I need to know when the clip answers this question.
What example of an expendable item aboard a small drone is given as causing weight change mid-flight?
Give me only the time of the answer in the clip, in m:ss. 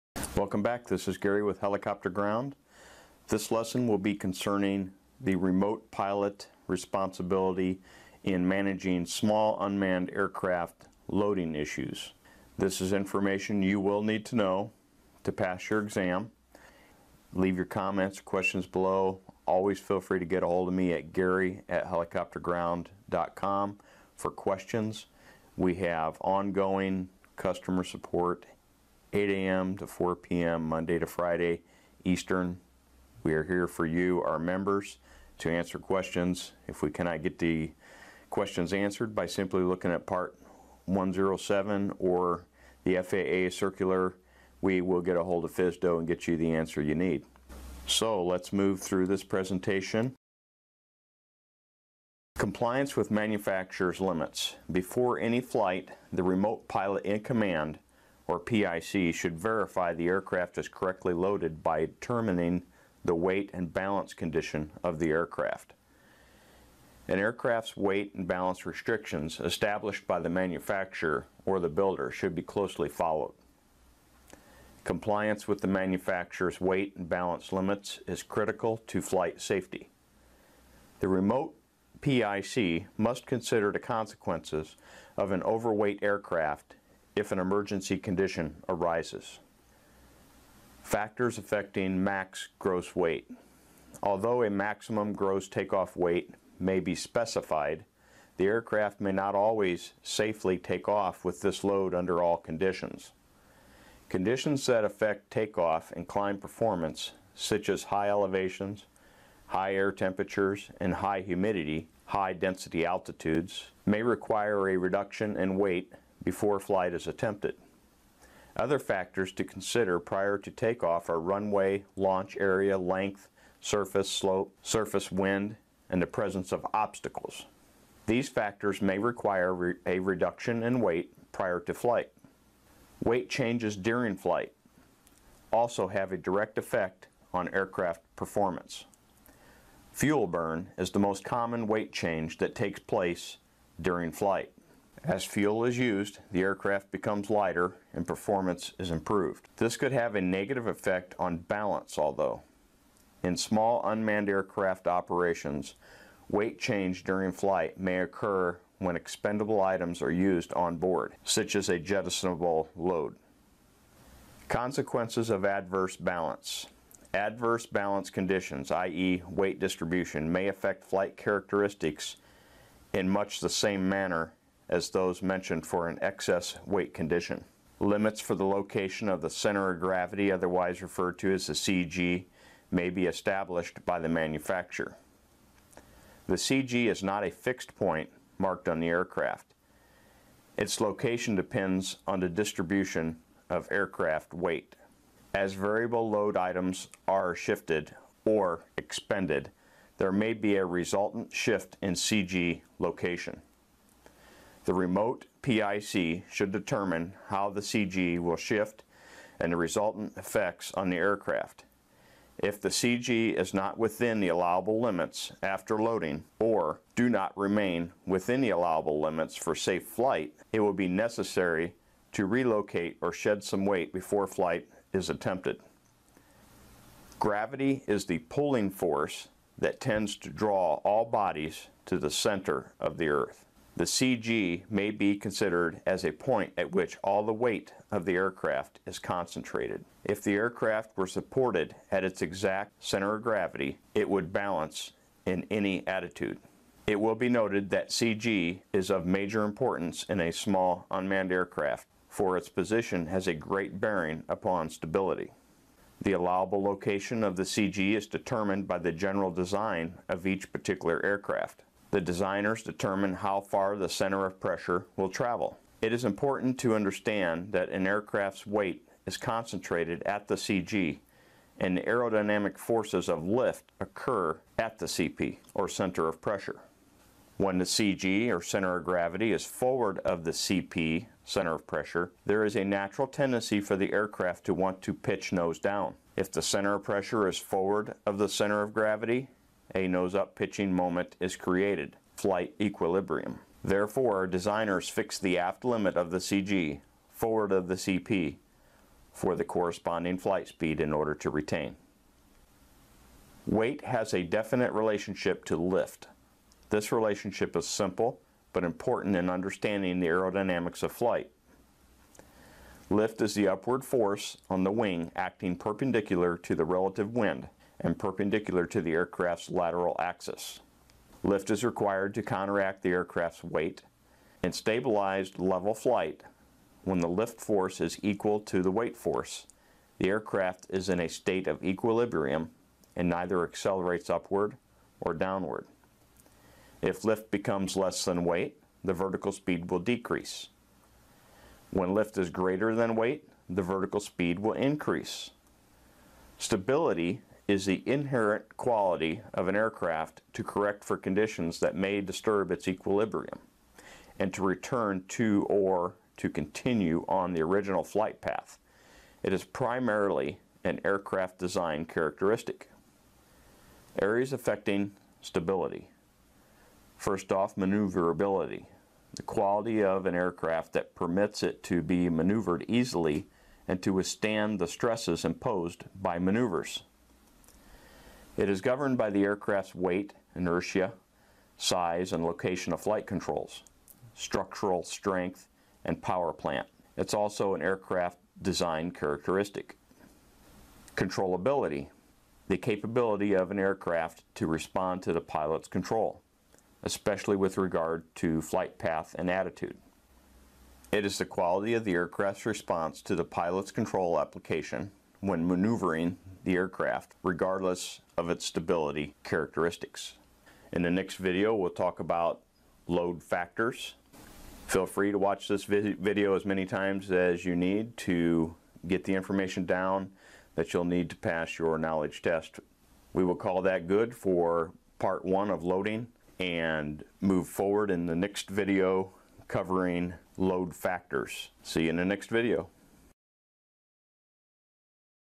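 2:41.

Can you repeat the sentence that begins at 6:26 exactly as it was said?
It's also an aircraft design characteristic.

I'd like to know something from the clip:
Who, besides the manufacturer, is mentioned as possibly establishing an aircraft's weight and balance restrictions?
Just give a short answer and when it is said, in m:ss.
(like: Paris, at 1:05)
The builder, at 1:11.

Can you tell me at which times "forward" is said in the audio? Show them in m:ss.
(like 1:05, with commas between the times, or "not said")
4:39, 4:47, 4:57, 7:07.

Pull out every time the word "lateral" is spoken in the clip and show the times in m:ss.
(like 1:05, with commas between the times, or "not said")
5:19.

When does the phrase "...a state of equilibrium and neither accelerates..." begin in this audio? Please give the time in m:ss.
5:30.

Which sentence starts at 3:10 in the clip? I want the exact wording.
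Its location depends on the distribution of aircraft weight.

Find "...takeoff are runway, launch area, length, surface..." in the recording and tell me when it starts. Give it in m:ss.
2:00.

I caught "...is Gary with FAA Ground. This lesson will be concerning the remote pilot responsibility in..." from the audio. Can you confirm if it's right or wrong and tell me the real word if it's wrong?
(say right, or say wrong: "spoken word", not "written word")
wrong: "Helicopter", not "FAA".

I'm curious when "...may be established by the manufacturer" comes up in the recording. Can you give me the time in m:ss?
3:02.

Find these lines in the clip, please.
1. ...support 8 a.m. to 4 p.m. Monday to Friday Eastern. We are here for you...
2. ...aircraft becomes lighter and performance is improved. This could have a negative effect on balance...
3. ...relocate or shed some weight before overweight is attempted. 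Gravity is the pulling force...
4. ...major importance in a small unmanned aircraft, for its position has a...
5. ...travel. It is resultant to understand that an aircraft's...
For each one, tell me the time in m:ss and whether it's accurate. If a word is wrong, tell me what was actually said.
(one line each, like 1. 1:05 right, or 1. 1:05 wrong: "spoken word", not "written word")
1. 0:27 right
2. 2:26 right
3. 3:42 wrong: "flight", not "overweight"
4. 4:09 right
5. 4:25 wrong: "important", not "resultant".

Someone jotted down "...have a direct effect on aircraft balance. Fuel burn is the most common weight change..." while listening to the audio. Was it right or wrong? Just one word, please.
wrong.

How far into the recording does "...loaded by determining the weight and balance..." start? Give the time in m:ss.
1:01.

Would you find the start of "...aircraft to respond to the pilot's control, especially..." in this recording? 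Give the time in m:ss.
6:33.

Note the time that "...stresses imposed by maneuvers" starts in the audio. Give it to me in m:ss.
6:14.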